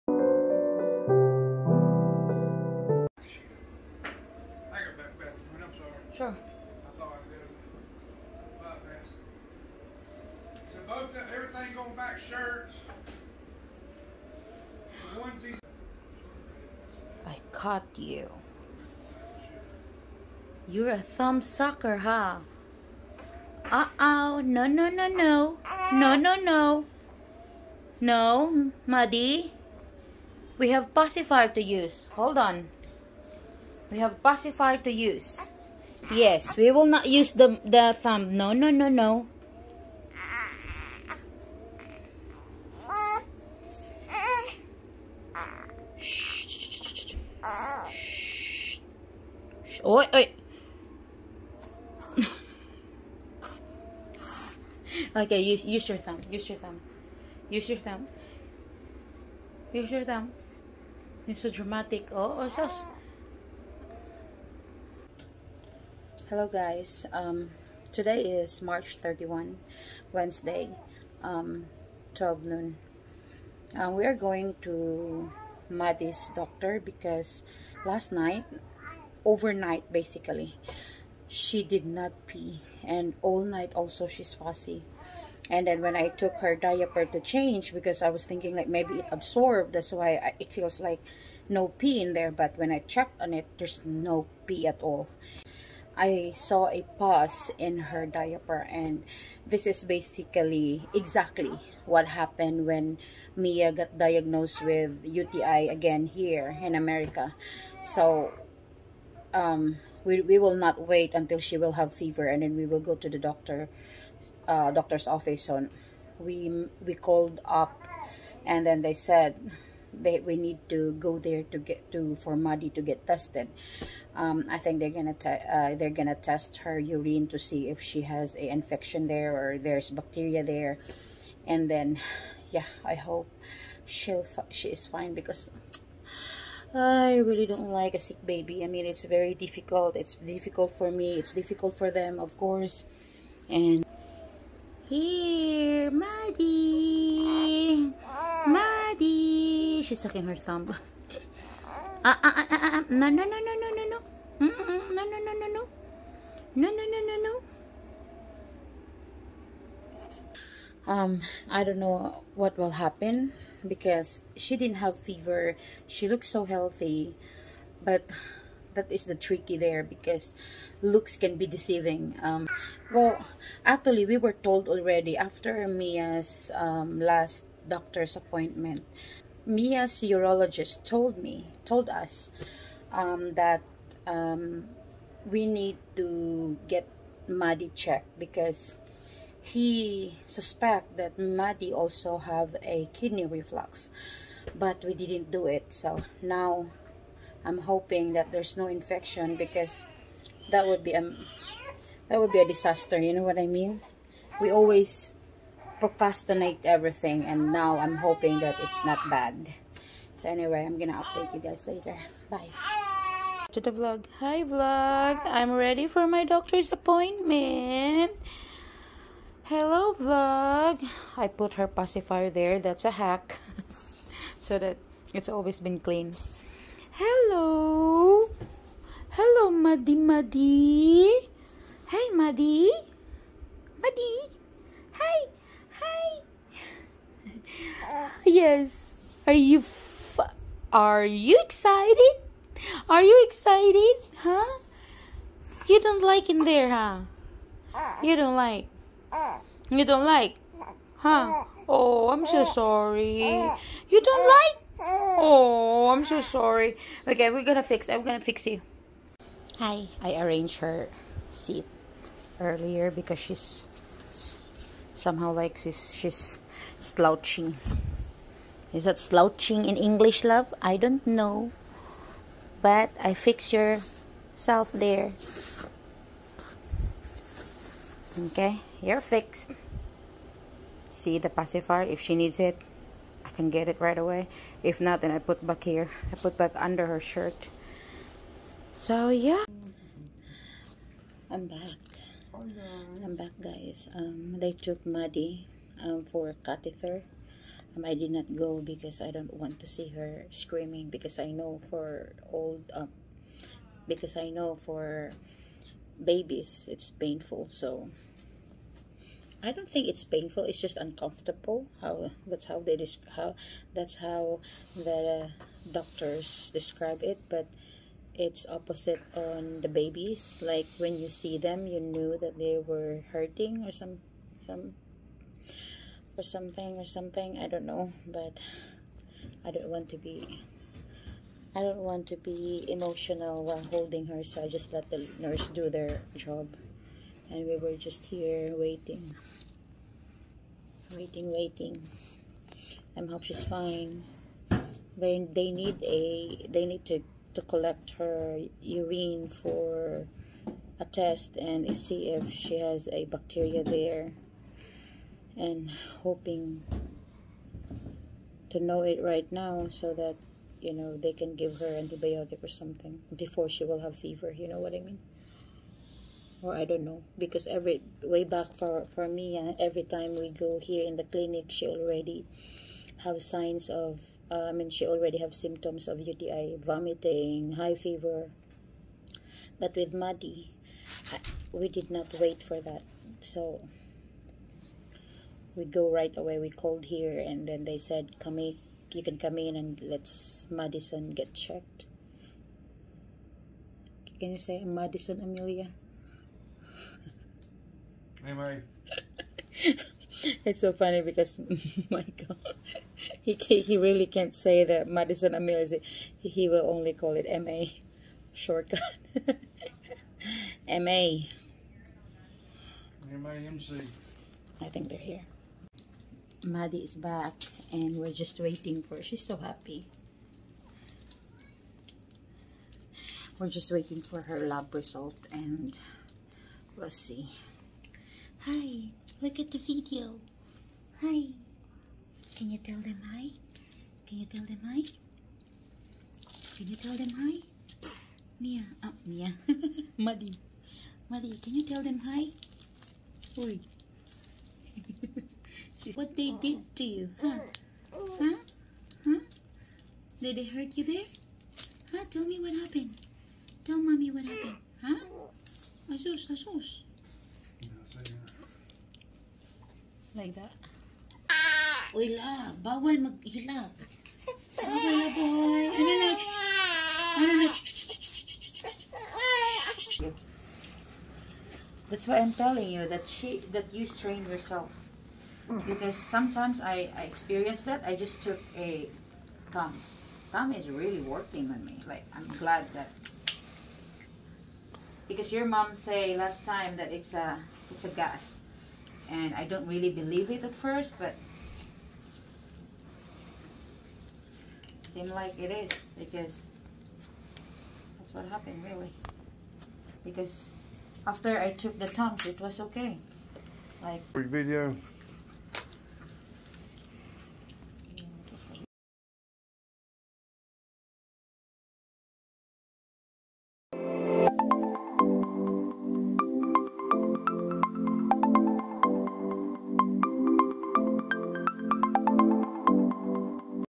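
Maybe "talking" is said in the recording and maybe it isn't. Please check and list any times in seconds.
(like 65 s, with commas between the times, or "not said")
not said.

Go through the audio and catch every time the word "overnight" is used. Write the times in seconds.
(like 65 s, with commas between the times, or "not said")
79 s.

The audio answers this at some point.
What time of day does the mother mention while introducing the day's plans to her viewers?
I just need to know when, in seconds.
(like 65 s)
72 s.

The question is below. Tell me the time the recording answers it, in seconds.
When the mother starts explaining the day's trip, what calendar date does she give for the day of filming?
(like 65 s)
68 s.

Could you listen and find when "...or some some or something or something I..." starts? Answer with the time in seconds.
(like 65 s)
323 s.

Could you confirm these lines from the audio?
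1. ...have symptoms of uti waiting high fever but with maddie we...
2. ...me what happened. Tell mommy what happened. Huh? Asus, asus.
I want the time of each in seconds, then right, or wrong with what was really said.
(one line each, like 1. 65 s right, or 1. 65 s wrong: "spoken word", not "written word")
1. 375 s wrong: "vomiting", not "waiting"
2. 452 s right.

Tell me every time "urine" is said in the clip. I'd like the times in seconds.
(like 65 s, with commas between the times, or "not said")
126 s, 348 s.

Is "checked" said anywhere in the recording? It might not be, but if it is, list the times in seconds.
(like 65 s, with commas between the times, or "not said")
92 s, 187 s, 391 s.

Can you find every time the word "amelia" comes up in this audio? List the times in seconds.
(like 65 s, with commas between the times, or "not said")
395 s, 405 s.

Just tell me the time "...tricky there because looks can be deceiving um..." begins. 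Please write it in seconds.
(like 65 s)
169 s.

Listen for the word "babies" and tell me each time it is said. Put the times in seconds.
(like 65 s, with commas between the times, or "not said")
306 s, 319 s.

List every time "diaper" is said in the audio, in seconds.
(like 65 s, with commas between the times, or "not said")
86 s, 98 s.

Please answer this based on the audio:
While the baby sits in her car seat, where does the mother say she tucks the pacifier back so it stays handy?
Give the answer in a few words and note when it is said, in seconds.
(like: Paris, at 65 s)
Under her shirt, at 286 s.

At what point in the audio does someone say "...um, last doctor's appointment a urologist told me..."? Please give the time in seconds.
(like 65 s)
176 s.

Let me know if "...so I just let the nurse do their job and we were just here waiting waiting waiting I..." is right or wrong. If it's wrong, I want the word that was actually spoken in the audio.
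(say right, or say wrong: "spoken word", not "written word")
right.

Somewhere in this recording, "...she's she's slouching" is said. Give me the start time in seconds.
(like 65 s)
265 s.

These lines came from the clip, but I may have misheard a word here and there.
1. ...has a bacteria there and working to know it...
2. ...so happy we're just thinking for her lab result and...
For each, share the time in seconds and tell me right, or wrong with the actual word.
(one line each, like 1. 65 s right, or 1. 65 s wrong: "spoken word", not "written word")
1. 352 s wrong: "hoping", not "working"
2. 419 s wrong: "waiting", not "thinking".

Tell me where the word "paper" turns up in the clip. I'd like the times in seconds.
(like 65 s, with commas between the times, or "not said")
not said.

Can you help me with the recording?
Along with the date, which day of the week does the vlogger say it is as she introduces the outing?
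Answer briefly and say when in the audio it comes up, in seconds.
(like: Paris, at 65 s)
Wednesday, at 70 s.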